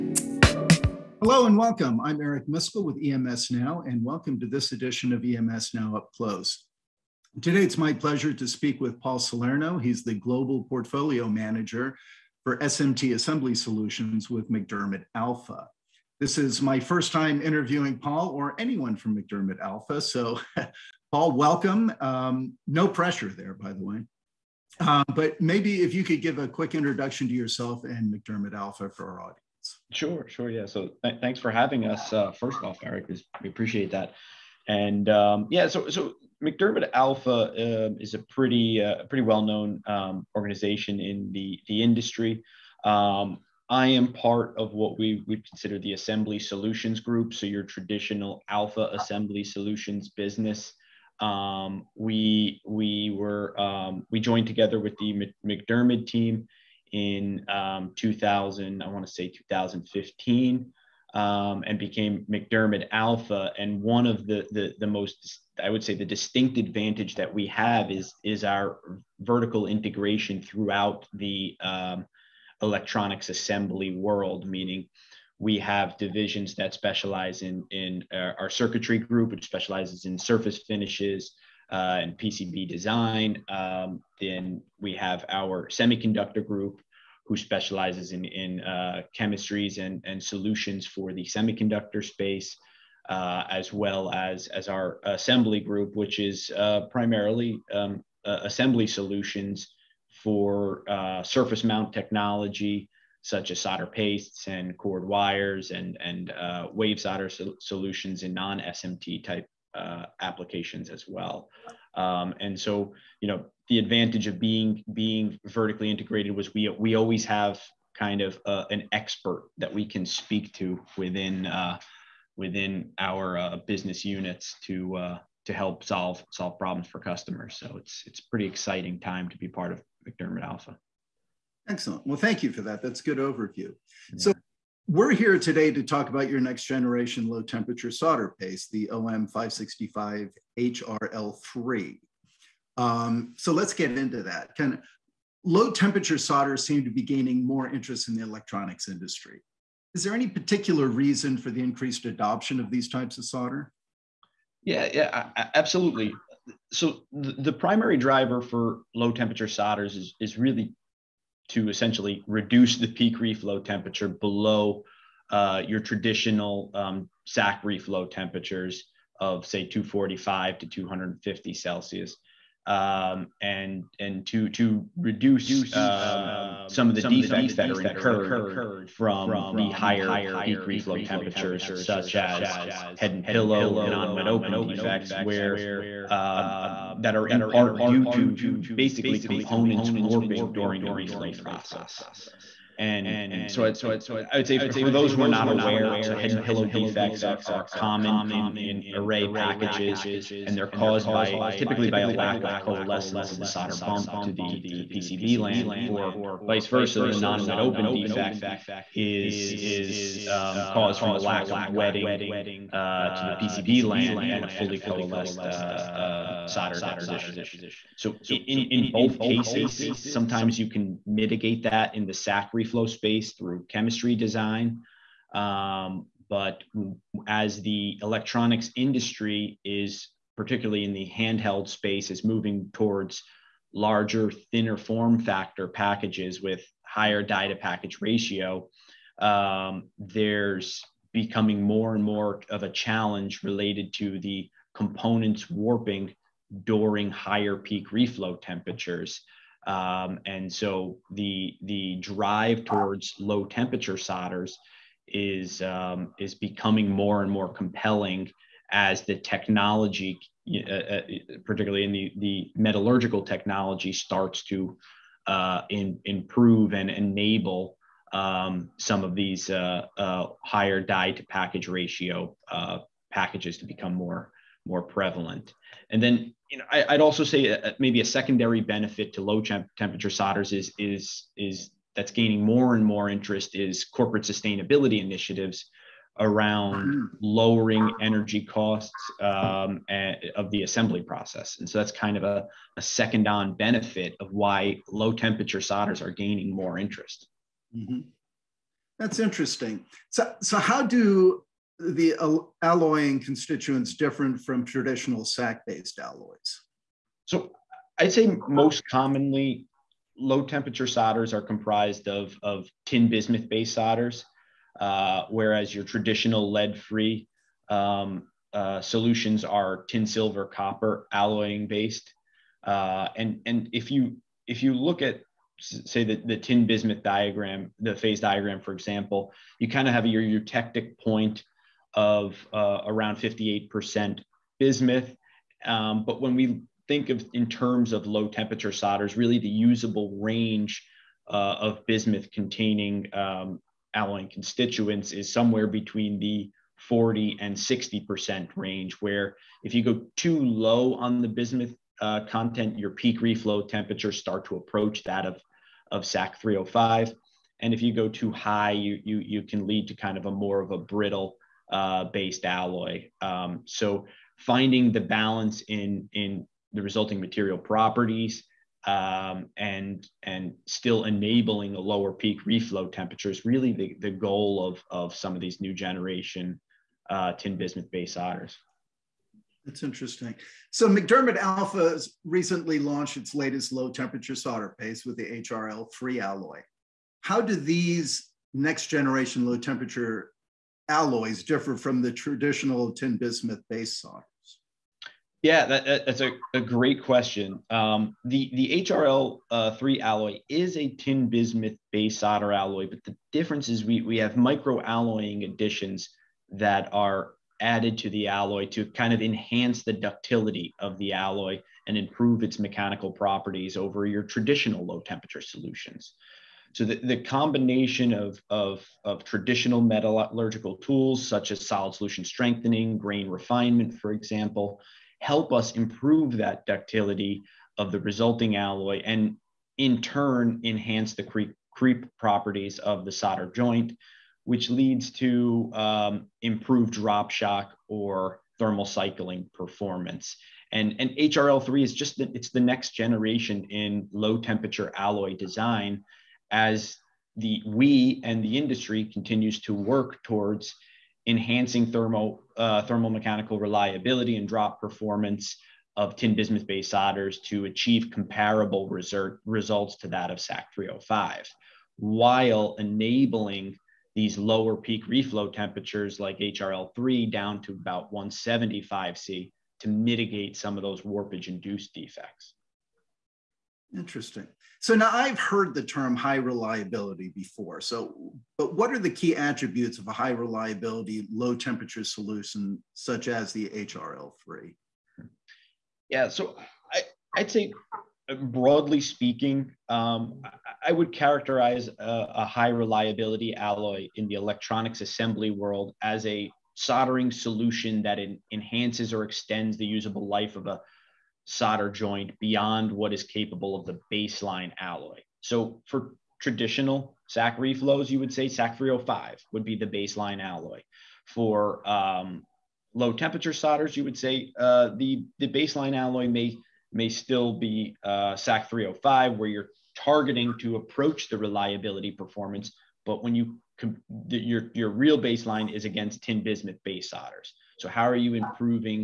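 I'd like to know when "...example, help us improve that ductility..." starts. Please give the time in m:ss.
7:04.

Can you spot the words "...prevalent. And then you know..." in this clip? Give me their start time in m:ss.
4:34.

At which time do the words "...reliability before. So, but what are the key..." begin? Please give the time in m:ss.
7:56.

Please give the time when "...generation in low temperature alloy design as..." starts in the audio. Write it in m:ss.
7:22.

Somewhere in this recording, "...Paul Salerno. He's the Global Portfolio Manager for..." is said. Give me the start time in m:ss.
0:09.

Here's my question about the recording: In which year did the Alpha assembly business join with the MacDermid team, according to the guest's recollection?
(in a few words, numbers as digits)
2015.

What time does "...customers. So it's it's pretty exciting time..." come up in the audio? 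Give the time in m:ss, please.
2:06.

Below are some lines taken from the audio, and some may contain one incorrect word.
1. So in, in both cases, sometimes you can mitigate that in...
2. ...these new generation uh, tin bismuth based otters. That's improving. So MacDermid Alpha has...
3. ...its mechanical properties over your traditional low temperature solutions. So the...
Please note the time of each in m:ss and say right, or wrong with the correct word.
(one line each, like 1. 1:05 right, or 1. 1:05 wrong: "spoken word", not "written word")
1. 3:37 right
2. 6:15 wrong: "interesting", not "improving"
3. 6:52 right.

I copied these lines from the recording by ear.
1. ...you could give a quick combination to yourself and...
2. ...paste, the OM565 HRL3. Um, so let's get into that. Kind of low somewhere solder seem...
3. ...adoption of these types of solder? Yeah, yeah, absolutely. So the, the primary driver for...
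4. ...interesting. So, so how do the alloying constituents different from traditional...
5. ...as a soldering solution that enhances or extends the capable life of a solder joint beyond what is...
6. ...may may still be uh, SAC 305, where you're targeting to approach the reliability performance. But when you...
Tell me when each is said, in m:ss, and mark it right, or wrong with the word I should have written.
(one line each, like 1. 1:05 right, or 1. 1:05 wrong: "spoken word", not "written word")
1. 0:25 wrong: "introduction", not "combination"
2. 2:18 wrong: "temperature", not "somewhere"
3. 2:32 right
4. 4:59 right
5. 8:16 wrong: "usable", not "capable"
6. 8:36 right.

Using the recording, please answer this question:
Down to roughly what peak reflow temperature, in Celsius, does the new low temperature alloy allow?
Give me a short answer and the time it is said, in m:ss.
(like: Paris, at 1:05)
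175, at 7:48.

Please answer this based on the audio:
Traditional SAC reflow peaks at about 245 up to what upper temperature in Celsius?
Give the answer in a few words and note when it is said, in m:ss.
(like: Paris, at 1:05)
250, at 2:50.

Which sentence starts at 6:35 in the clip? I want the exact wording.
Yeah, that, that's a, a, great question.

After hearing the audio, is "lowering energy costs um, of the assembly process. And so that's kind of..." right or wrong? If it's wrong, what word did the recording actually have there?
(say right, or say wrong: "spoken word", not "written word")
right.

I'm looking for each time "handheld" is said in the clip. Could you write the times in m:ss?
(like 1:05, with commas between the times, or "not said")
3:51.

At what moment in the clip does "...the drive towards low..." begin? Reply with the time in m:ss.
4:11.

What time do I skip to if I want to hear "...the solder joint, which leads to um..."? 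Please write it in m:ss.
7:13.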